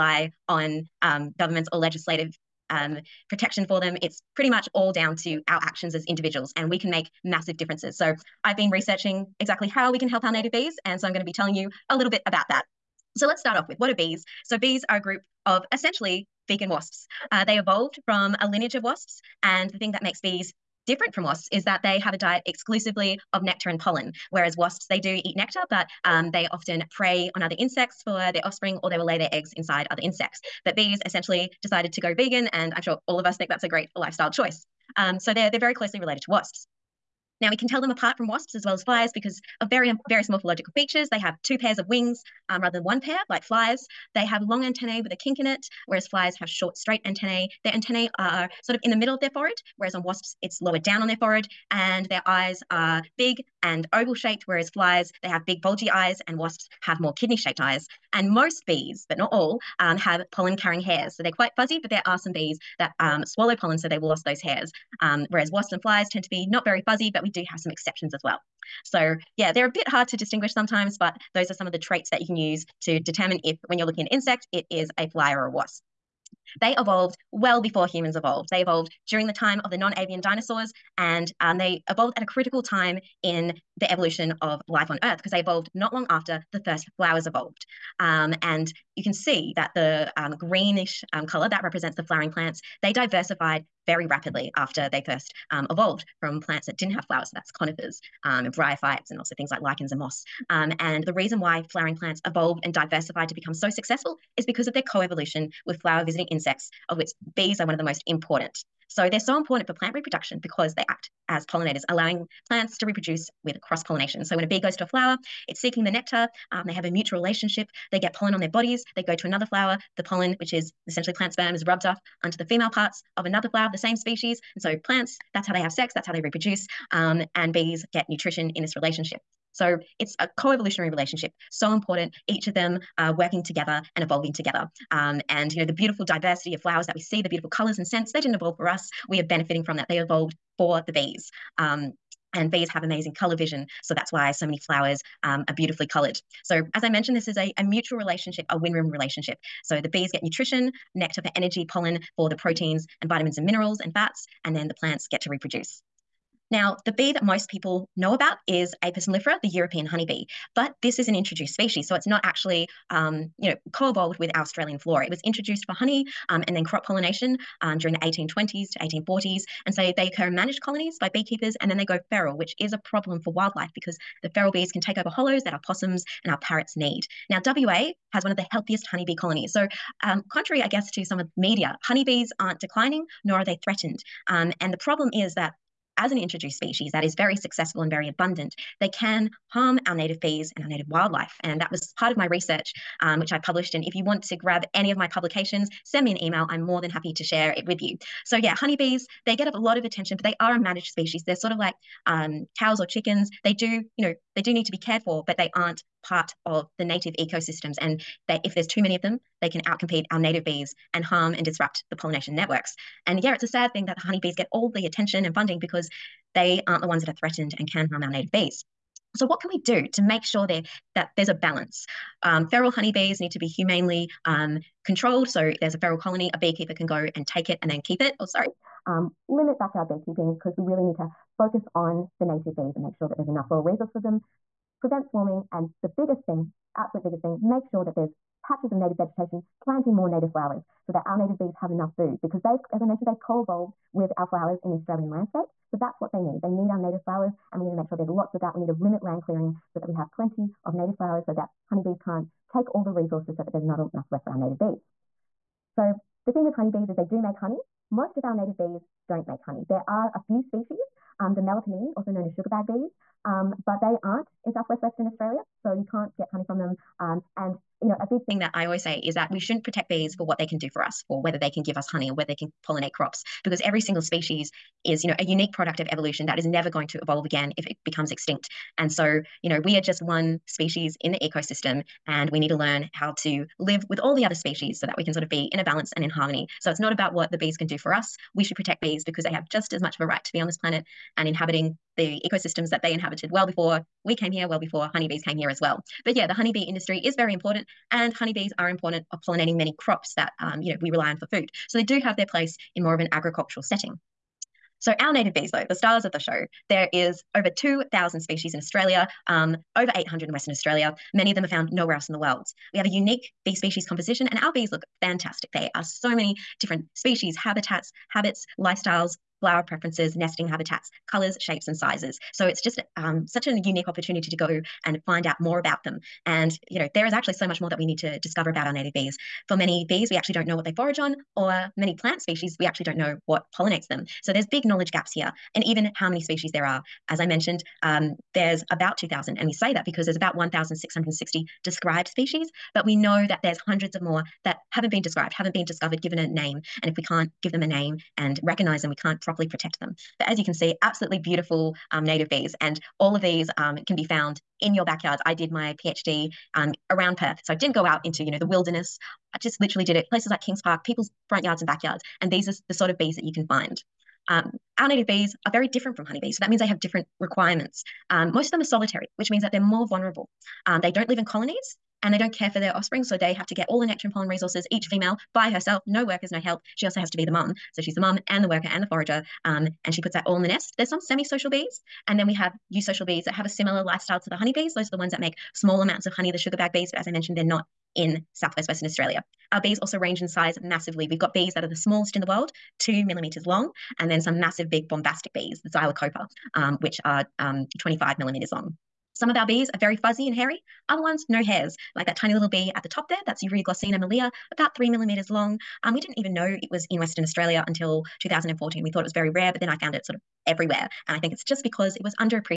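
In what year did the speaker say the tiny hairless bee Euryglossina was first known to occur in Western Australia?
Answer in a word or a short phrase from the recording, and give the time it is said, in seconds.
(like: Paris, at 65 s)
2014, at 408 s.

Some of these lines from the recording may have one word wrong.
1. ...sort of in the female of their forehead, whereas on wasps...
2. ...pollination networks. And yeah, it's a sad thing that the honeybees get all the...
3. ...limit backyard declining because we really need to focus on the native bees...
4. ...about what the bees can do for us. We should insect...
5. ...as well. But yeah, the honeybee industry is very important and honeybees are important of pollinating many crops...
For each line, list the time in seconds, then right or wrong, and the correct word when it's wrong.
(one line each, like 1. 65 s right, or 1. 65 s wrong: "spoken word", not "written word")
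1. 48 s wrong: "middle", not "female"
2. 211 s right
3. 229 s wrong: "beekeeping", not "declining"
4. 286 s wrong: "protect", not "insect"
5. 295 s right.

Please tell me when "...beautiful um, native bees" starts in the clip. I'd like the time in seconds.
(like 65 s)
351 s.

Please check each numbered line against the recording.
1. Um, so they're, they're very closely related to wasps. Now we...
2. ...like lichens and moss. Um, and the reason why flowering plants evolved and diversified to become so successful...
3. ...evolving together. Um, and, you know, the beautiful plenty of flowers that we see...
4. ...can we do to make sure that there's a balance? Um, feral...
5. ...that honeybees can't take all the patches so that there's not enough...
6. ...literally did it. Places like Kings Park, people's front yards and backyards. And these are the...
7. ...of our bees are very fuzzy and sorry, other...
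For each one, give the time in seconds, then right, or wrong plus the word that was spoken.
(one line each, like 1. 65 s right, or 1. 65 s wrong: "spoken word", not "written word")
1. 34 s right
2. 99 s right
3. 134 s wrong: "diversity", not "plenty"
4. 219 s right
5. 251 s wrong: "resources", not "patches"
6. 359 s right
7. 399 s wrong: "hairy", not "sorry".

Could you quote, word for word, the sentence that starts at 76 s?
They evolved well before humans evolved.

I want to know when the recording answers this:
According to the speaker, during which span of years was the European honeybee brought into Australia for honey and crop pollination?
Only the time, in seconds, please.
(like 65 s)
167 s.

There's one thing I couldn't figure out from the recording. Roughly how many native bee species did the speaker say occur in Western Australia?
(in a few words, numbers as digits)
over 800.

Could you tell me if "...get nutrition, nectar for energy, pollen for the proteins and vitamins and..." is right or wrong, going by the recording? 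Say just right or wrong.
right.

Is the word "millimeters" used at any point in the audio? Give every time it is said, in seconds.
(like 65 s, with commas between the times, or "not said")
393 s, 398 s, 404 s.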